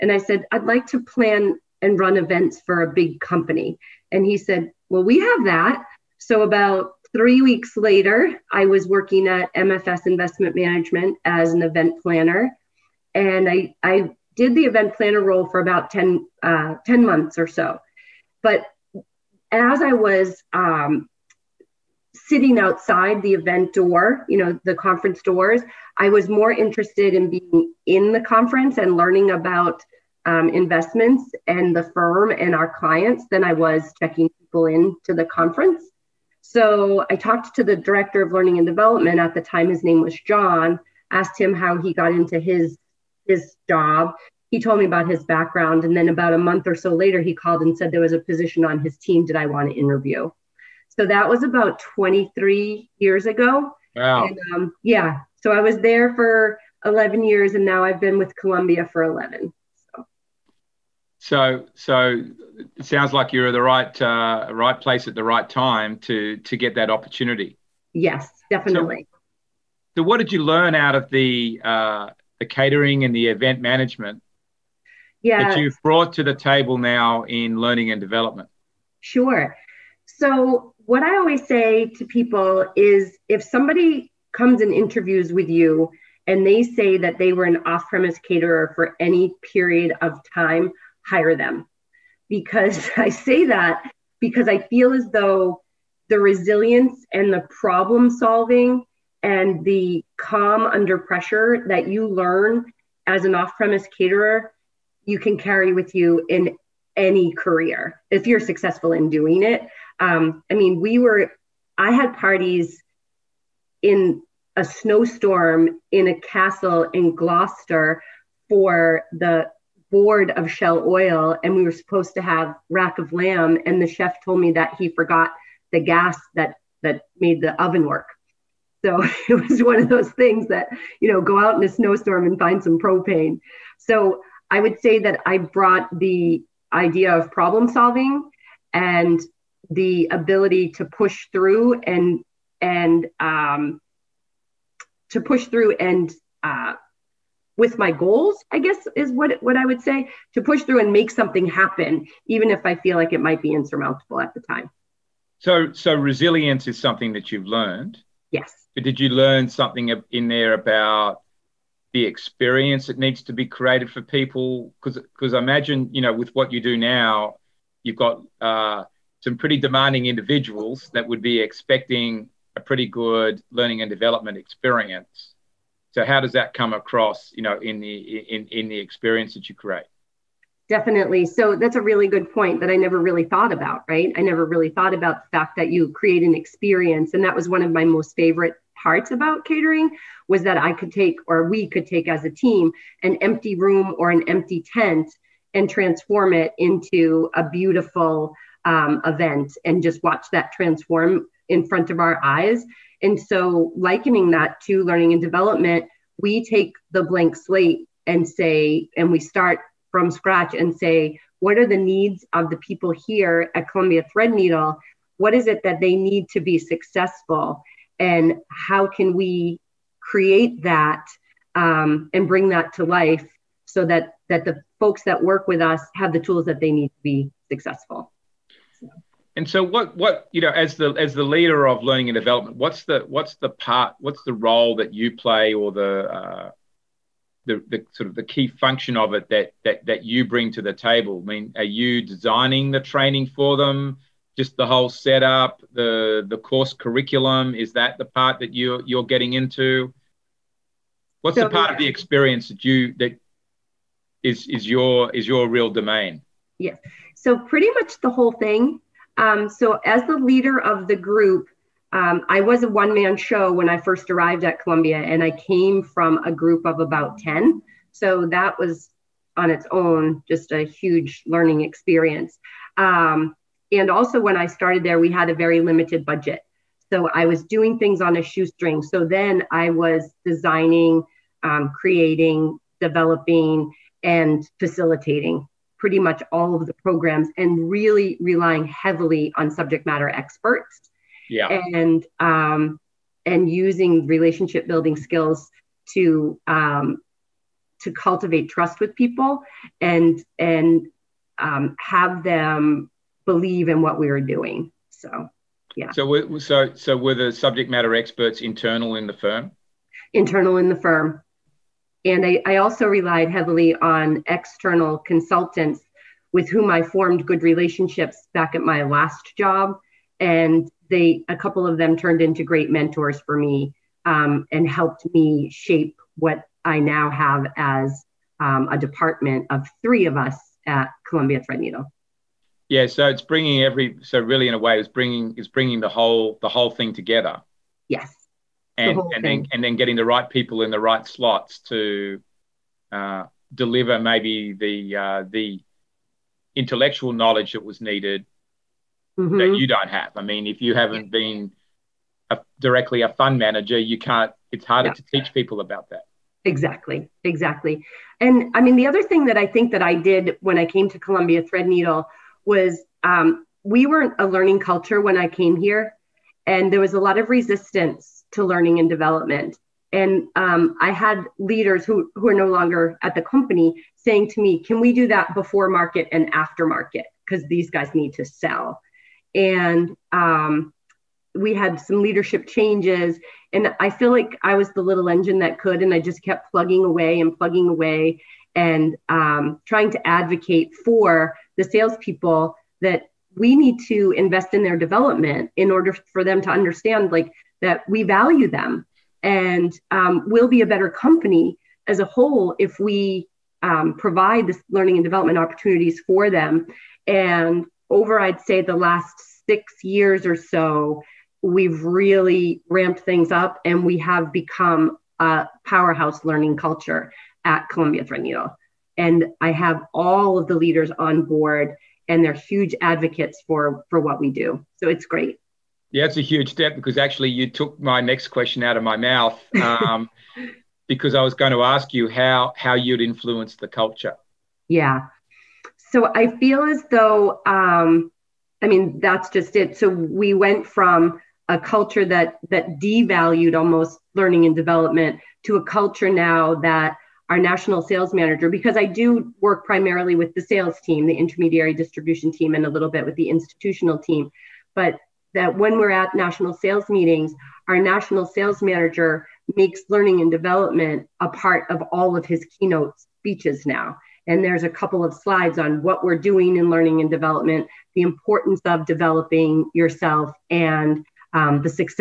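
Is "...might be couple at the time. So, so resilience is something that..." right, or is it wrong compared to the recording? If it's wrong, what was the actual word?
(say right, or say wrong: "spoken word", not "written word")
wrong: "insurmountable", not "couple".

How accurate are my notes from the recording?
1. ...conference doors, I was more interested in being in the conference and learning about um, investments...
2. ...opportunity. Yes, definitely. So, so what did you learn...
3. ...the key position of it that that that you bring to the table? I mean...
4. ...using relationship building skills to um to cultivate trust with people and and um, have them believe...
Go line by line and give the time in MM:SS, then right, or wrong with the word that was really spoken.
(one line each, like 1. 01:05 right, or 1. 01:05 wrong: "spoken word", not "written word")
1. 00:24 right
2. 01:06 right
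3. 03:58 wrong: "function", not "position"
4. 04:53 right.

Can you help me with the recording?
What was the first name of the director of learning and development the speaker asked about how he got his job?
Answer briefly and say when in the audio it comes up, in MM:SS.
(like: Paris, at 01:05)
John, at 00:40.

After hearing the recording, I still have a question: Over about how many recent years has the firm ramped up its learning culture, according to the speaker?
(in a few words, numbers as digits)
6.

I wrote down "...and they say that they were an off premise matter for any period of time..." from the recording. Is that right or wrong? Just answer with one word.
wrong.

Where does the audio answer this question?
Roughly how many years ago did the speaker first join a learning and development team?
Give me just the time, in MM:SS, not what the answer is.
00:51.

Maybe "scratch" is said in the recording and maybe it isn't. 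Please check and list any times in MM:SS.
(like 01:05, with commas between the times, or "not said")
03:30.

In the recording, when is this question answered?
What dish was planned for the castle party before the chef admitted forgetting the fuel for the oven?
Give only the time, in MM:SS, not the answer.
02:02.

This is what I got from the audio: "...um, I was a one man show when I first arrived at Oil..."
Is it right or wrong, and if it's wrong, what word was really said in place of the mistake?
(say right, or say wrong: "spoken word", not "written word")
wrong: "Columbia", not "Oil".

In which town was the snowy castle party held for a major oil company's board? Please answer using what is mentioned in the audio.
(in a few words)
Gloucester.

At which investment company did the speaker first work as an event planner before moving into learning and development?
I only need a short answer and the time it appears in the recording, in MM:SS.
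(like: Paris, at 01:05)
MFS Investment Management, at 00:09.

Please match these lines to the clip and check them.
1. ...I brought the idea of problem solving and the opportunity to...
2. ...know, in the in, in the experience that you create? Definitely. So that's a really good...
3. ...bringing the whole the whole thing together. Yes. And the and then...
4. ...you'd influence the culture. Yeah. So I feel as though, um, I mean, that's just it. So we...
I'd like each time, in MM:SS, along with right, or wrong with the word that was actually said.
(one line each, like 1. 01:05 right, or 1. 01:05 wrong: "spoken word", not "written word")
1. 02:15 wrong: "ability", not "opportunity"
2. 02:57 right
3. 05:35 right
4. 07:12 right.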